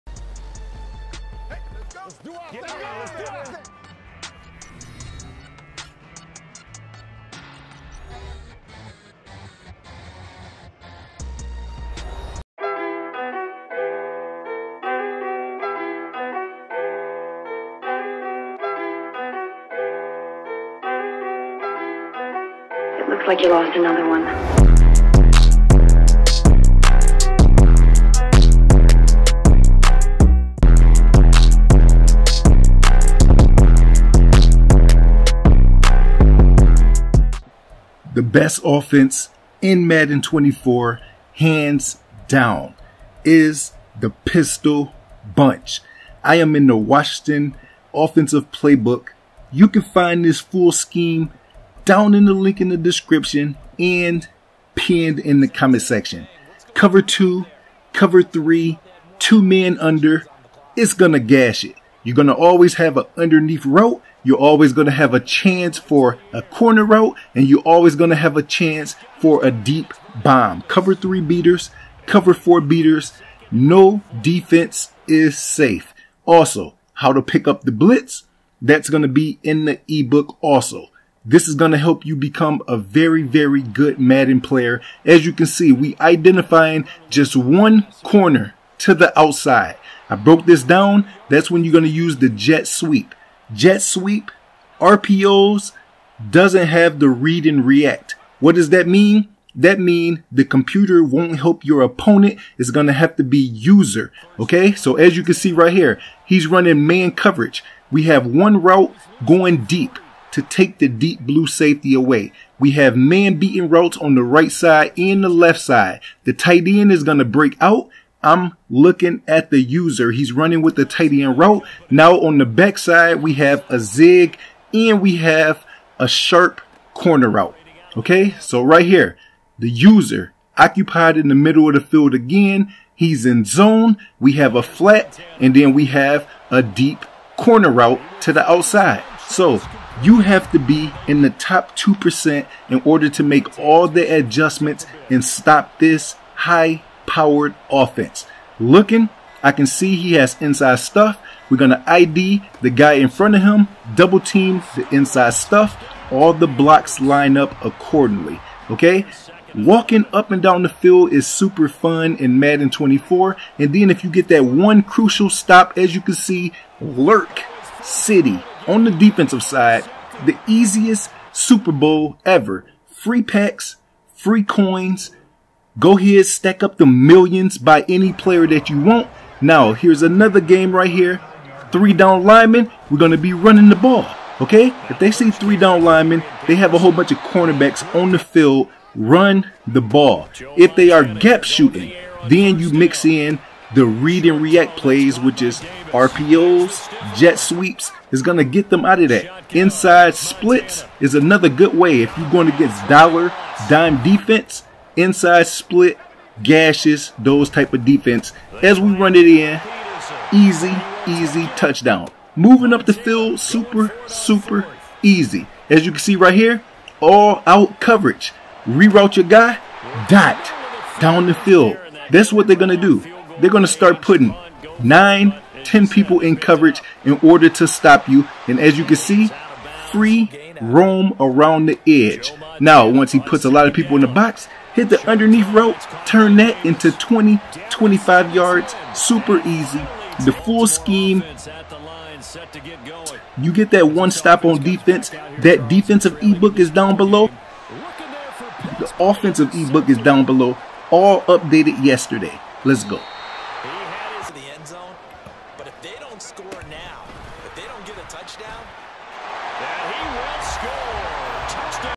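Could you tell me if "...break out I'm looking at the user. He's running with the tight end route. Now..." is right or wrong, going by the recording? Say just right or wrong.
right.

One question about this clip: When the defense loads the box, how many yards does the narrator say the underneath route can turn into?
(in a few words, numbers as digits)
20 to 25 yards.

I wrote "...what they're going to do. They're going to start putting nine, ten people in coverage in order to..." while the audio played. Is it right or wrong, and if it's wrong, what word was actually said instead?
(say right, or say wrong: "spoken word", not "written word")
right.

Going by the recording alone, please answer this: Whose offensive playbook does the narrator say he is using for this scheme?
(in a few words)
Washington.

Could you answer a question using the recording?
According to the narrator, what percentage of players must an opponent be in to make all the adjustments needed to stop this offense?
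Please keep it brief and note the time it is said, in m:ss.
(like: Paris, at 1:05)
Top 2%, at 2:21.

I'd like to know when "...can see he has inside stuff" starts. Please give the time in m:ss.
2:29.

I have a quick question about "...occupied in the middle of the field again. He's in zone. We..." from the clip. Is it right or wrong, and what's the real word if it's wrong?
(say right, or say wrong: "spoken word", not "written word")
right.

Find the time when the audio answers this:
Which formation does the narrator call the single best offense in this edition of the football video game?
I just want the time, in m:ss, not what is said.
0:44.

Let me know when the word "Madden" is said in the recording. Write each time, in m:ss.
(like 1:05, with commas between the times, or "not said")
0:39, 1:23, 2:42.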